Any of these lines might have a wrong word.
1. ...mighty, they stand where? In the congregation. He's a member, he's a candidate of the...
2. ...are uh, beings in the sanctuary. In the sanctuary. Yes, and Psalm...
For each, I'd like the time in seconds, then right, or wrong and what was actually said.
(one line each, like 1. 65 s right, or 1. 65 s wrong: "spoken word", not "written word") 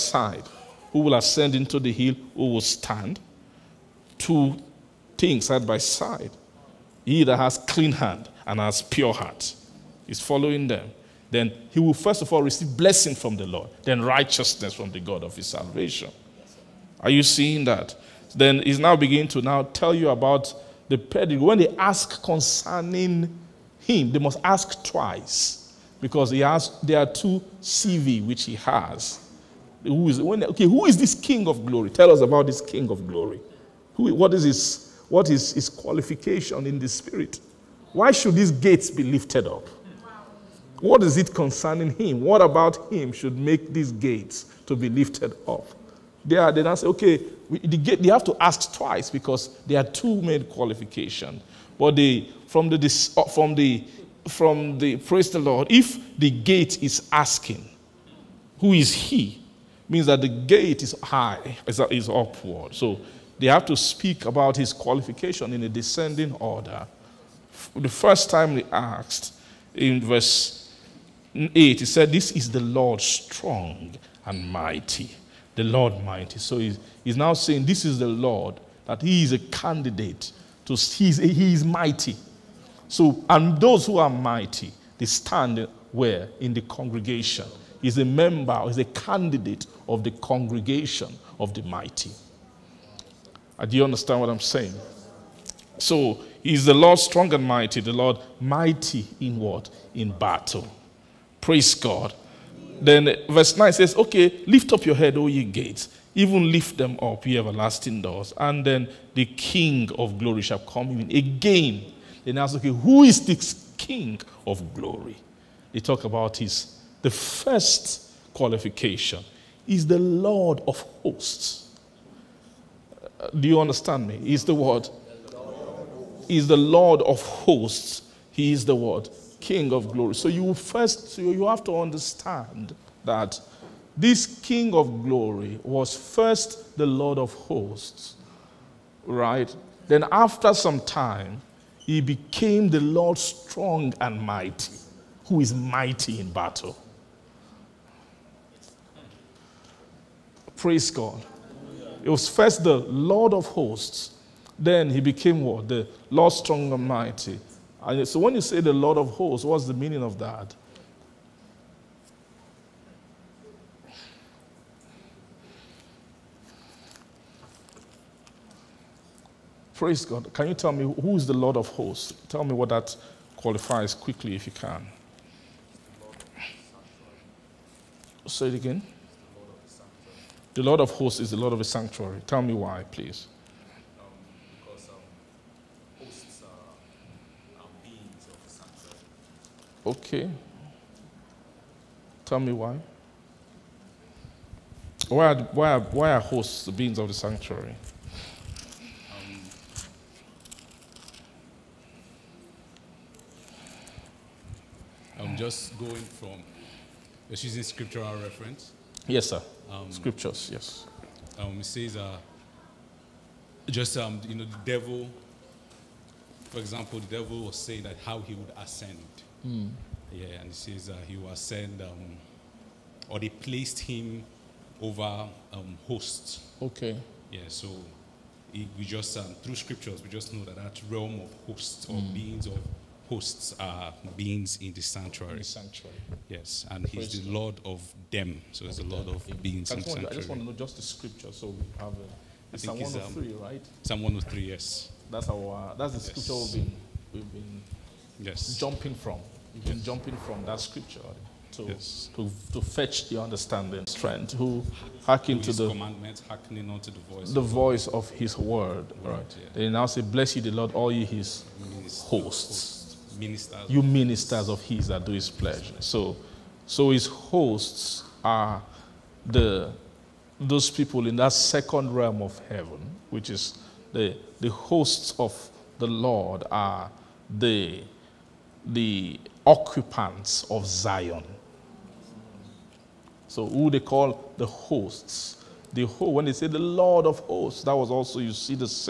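1. 84 s right
2. 233 s wrong: "Praise", not "Psalm".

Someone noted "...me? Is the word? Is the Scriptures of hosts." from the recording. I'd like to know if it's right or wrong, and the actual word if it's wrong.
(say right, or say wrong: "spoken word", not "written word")
wrong: "Lord", not "Scriptures".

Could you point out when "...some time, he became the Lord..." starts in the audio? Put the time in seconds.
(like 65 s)
140 s.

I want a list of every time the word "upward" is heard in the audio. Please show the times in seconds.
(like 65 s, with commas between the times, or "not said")
62 s.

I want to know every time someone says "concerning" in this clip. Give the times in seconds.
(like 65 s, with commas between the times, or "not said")
22 s, 41 s.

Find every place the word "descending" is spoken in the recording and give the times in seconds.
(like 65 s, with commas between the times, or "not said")
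65 s.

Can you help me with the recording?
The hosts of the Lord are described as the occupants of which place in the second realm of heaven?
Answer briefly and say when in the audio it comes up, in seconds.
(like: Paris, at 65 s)
Zion, at 280 s.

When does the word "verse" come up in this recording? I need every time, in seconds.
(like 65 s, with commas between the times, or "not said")
70 s, 103 s.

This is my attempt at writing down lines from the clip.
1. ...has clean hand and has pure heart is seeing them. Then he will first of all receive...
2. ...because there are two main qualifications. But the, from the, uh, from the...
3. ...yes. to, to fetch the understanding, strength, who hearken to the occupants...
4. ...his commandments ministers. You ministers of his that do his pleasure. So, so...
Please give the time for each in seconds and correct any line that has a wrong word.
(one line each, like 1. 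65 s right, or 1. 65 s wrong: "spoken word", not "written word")
1. 7 s wrong: "following", not "seeing"
2. 49 s right
3. 251 s wrong: "commandments", not "occupants"
4. 261 s wrong: "hosts", not "commandments".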